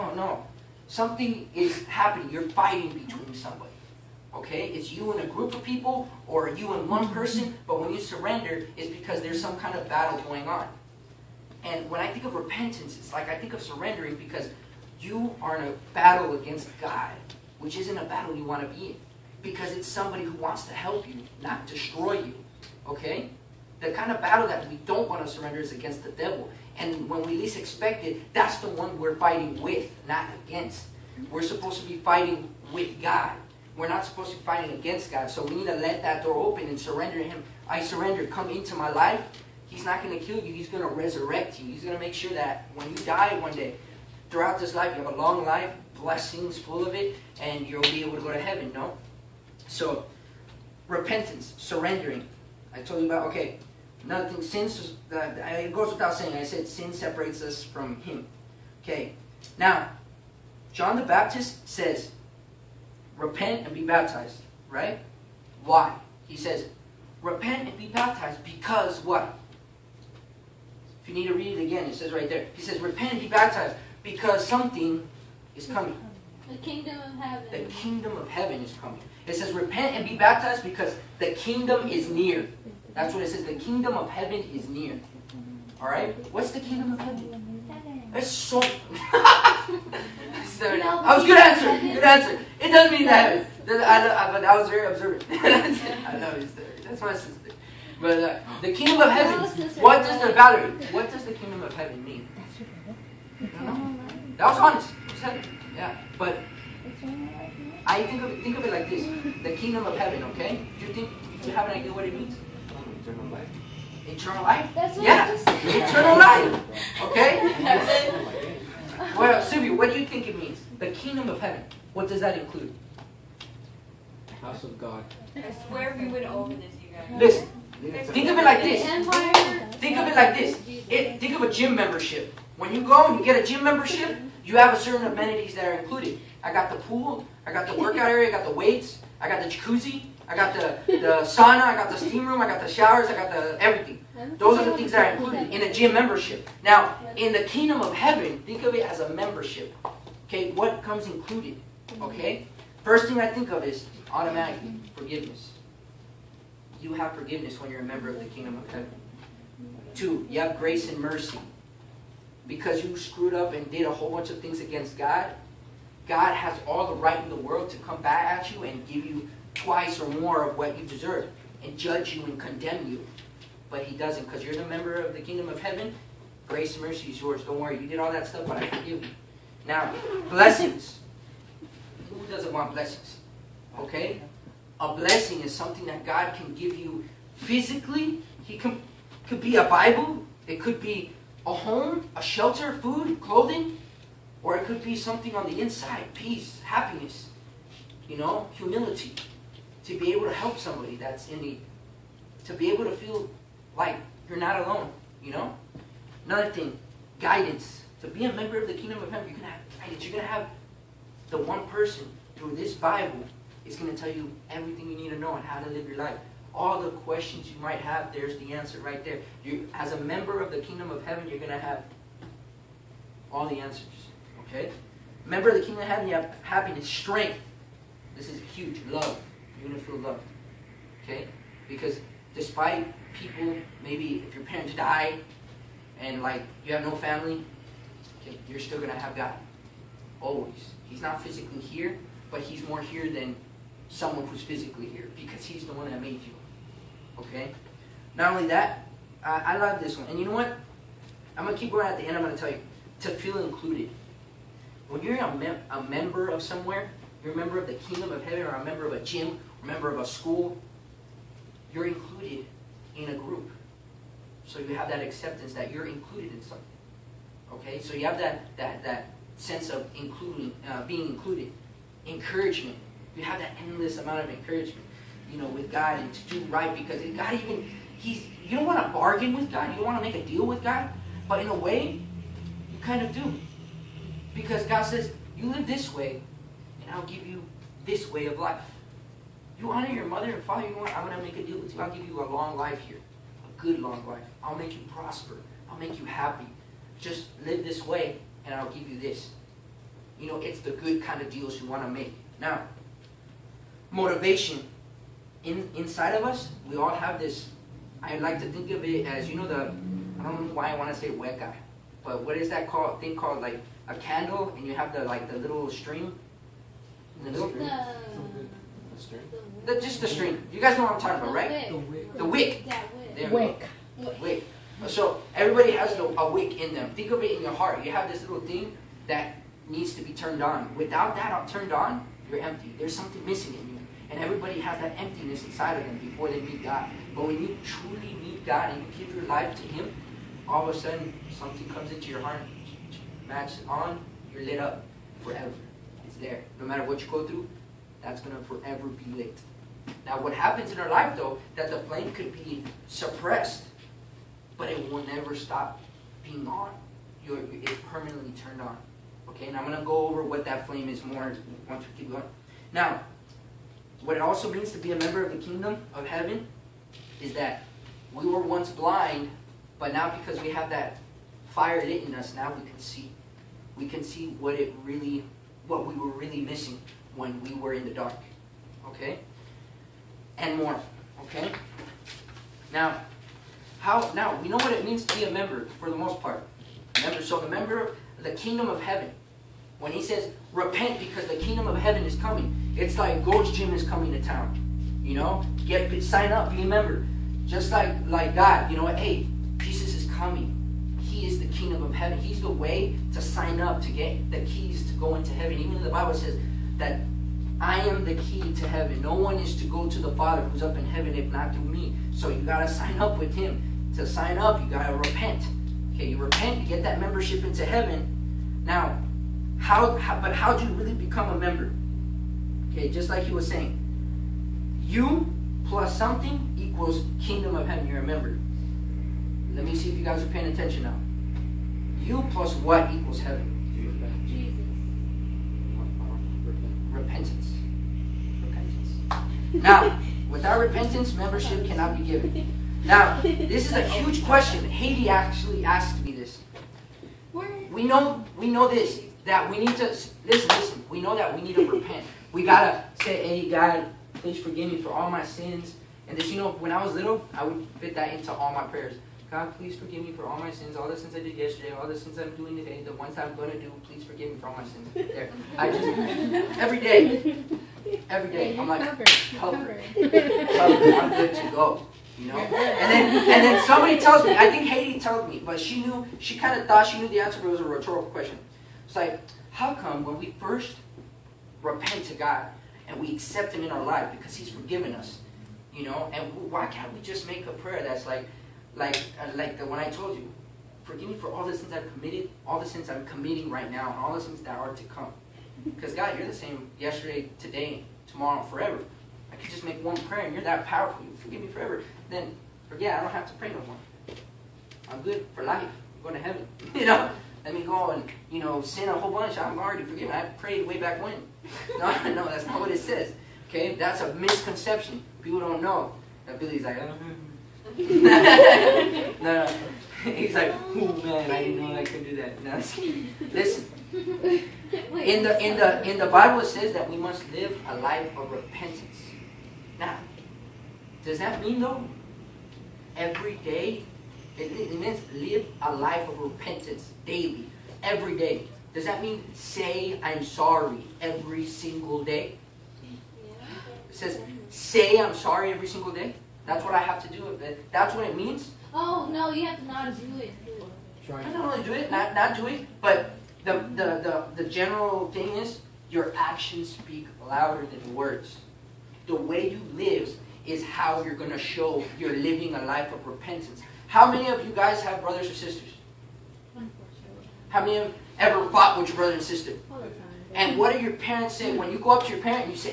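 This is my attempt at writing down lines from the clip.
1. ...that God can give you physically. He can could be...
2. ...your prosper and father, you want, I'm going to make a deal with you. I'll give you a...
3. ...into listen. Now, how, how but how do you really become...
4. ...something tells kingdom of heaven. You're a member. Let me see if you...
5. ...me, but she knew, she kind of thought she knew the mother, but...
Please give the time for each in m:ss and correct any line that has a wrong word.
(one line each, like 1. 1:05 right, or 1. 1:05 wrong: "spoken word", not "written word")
1. 3:05 right
2. 4:49 wrong: "mother", not "prosper"
3. 6:57 wrong: "heaven", not "listen"
4. 7:05 wrong: "equals", not "tells"
5. 7:55 wrong: "answer", not "mother".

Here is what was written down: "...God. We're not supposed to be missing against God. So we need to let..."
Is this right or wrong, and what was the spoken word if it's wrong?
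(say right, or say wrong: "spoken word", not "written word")
wrong: "fighting", not "missing".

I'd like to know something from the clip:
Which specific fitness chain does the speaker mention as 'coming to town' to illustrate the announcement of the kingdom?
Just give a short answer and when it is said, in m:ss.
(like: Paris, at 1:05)
Gold's Gym, at 6:33.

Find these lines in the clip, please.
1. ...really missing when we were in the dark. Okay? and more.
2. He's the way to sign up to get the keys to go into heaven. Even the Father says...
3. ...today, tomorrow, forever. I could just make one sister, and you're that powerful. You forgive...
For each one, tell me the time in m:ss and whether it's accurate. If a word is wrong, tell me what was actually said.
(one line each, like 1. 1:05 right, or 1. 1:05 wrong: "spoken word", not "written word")
1. 6:16 right
2. 6:42 wrong: "Bible", not "Father"
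3. 8:17 wrong: "prayer", not "sister".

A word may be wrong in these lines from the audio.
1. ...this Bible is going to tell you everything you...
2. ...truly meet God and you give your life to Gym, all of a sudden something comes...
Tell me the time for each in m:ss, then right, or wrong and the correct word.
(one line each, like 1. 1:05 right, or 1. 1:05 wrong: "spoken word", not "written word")
1. 3:32 right
2. 5:37 wrong: "Him", not "Gym".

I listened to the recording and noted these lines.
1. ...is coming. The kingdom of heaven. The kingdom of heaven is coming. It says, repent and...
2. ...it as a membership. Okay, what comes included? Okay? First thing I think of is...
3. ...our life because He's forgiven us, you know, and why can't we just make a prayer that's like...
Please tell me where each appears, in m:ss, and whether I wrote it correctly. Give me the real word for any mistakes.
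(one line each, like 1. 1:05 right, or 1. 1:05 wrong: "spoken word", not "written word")
1. 1:15 right
2. 2:28 right
3. 8:03 right.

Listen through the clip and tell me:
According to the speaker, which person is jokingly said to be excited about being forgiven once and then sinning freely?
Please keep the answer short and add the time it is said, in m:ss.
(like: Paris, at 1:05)
Billy, at 8:36.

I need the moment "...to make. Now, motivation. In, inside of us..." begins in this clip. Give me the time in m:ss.
5:01.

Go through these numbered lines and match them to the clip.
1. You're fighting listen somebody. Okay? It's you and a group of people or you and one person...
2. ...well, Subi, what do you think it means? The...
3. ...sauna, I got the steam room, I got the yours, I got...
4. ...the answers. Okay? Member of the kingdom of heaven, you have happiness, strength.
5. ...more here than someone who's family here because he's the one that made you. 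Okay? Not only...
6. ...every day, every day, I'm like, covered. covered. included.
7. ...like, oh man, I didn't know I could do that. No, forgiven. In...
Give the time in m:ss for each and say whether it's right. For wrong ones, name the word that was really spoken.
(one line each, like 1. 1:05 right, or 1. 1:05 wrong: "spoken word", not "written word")
1. 0:02 wrong: "between", not "listen"
2. 1:59 right
3. 2:21 wrong: "showers", not "yours"
4. 3:43 right
5. 4:02 wrong: "physically", not "family"
6. 7:46 wrong: "covered", not "included"
7. 8:40 wrong: "listen", not "forgiven".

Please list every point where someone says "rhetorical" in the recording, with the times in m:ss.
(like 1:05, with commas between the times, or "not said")
7:57.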